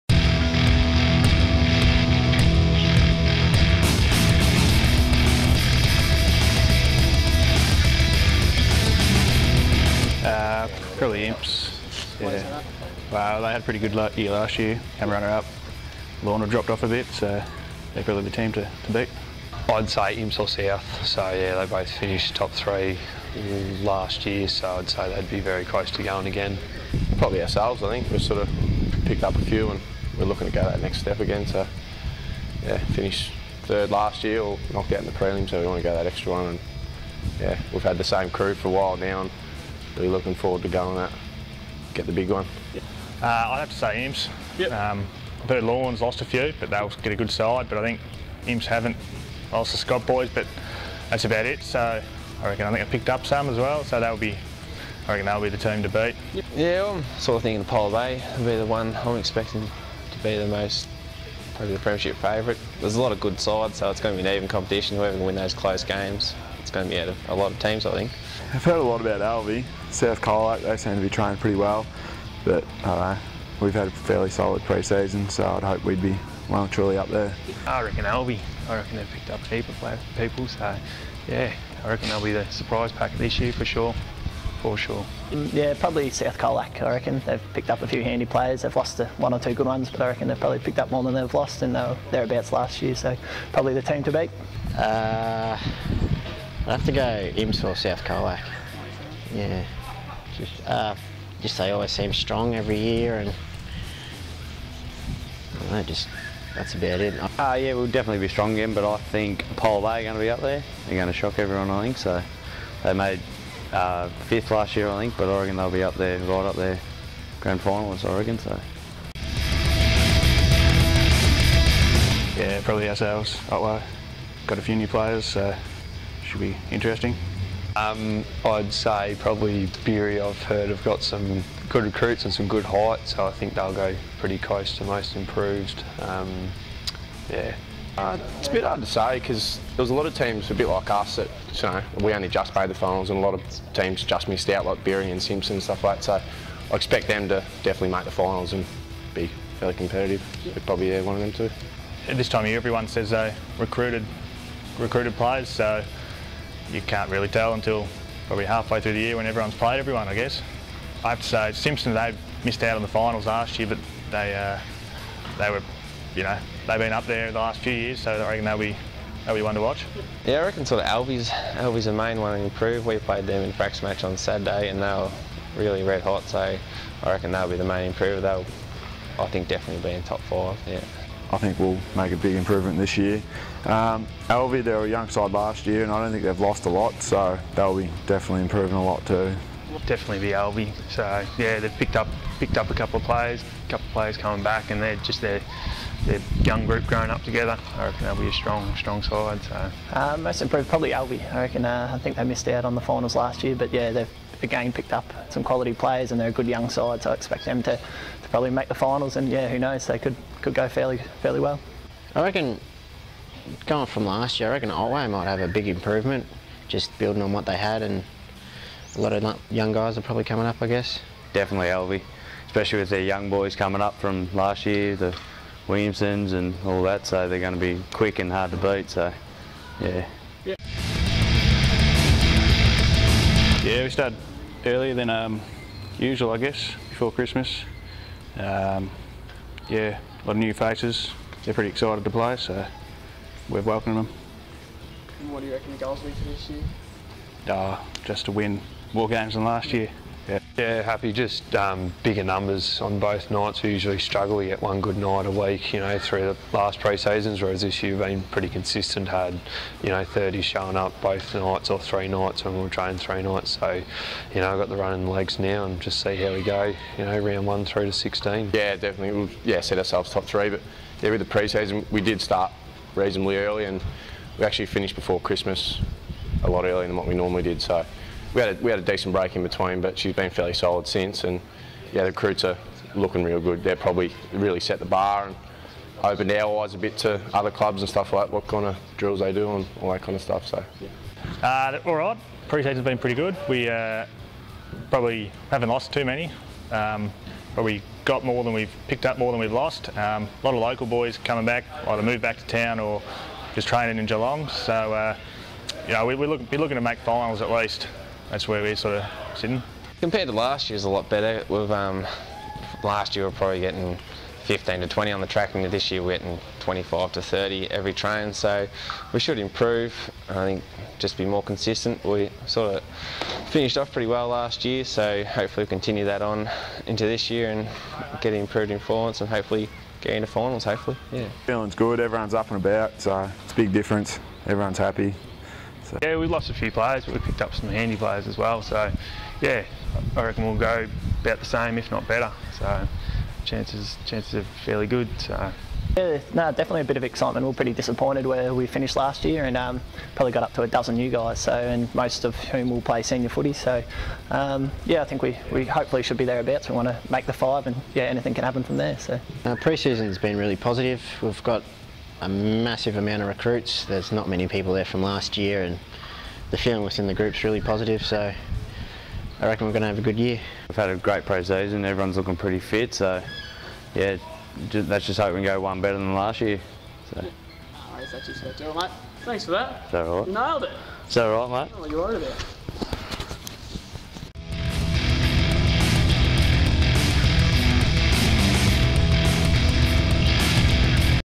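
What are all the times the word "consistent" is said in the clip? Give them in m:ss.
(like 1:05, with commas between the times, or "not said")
4:18, 5:21.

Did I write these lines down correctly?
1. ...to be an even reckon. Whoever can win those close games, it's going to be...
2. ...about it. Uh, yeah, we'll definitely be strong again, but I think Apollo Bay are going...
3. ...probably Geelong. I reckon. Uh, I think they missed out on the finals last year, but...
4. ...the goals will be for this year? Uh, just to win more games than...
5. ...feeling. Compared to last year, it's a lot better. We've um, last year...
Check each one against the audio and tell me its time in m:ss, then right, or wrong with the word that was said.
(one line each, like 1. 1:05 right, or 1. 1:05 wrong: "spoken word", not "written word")
1. 1:04 wrong: "competition", not "reckon"
2. 1:46 right
3. 3:20 wrong: "Alvie", not "Geelong"
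4. 4:05 right
5. 5:09 wrong: "sitting", not "feeling".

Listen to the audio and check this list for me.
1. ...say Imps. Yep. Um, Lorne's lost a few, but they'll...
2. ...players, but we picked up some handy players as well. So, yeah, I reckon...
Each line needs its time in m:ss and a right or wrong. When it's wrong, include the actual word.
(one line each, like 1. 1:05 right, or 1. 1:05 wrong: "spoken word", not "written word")
1. 0:43 right
2. 5:36 right.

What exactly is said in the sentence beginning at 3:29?
They could could go fairly fairly well.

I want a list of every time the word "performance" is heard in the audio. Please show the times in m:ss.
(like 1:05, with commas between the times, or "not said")
5:28.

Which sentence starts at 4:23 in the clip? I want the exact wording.
So, you know, I've got the running legs now and just see how we go, you know, round one through to 16.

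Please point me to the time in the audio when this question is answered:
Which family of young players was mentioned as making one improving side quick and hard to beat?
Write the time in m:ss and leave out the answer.
3:44.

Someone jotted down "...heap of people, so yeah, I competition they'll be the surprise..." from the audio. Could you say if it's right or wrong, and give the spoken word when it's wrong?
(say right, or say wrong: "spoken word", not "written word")
wrong: "reckon", not "competition".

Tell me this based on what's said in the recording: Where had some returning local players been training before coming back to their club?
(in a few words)
Geelong.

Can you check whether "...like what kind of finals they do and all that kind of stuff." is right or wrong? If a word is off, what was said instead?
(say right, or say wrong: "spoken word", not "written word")
wrong: "drills", not "finals".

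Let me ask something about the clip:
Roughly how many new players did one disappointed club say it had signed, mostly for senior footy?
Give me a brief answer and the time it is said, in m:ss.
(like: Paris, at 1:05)
a dozen, at 5:50.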